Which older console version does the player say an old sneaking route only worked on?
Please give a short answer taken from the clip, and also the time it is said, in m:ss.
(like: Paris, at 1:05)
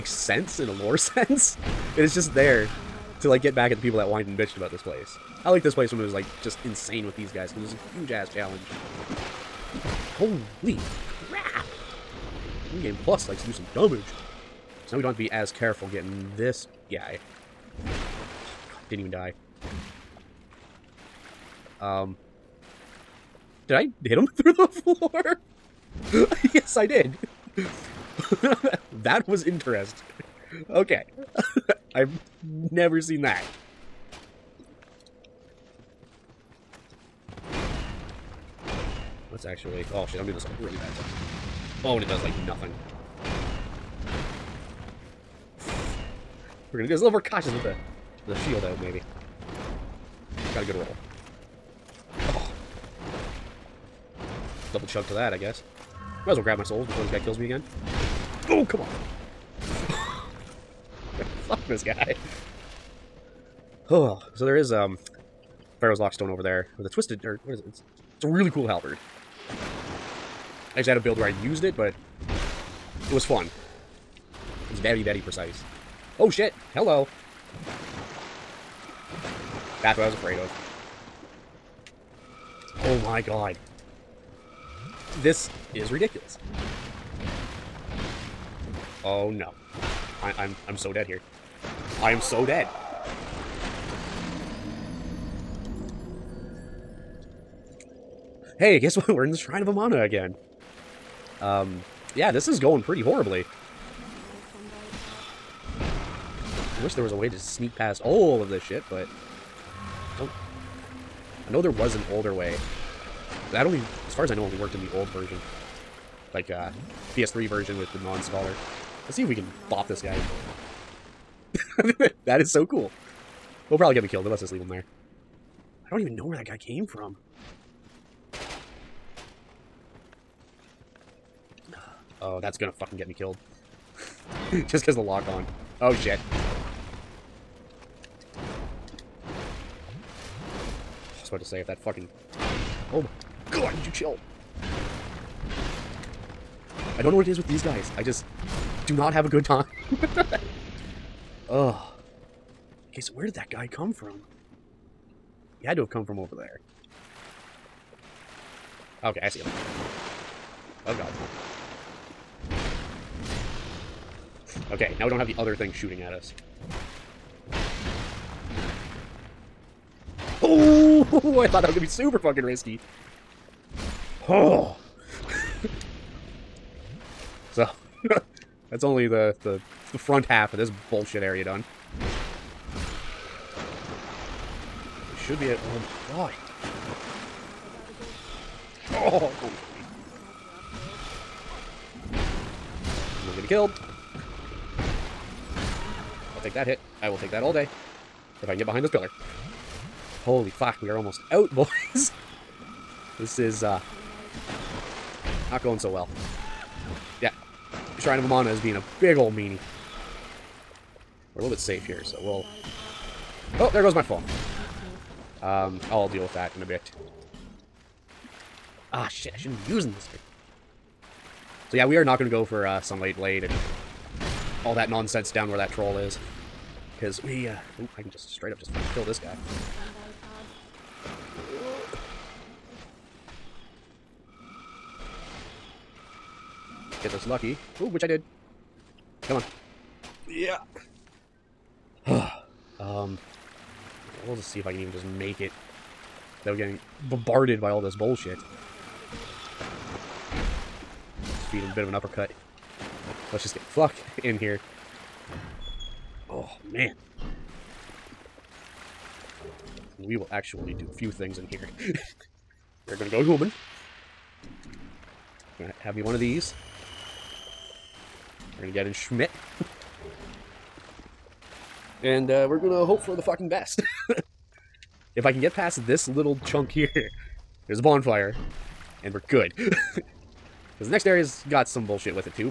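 PS3, at 1:57.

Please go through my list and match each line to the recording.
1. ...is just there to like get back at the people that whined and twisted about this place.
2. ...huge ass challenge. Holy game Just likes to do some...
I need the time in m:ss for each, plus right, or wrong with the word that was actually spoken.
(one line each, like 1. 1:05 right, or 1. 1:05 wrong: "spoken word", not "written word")
1. 0:02 wrong: "bitched", not "twisted"
2. 0:08 wrong: "Plus", not "Just".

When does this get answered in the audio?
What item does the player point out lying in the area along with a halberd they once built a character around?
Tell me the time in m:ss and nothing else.
1:05.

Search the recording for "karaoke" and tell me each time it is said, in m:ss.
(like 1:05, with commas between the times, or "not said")
not said.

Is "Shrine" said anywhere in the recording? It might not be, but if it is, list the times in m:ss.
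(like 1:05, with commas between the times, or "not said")
1:39, 3:27.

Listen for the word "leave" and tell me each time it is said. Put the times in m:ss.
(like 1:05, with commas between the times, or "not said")
2:04.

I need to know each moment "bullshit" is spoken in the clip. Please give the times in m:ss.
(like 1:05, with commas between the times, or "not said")
3:00, 4:07, 4:41.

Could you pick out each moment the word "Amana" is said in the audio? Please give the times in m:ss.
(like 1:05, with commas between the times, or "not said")
1:39, 3:28.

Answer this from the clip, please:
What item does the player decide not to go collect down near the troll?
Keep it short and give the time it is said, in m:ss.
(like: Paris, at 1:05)
Sunlight Blade, at 3:42.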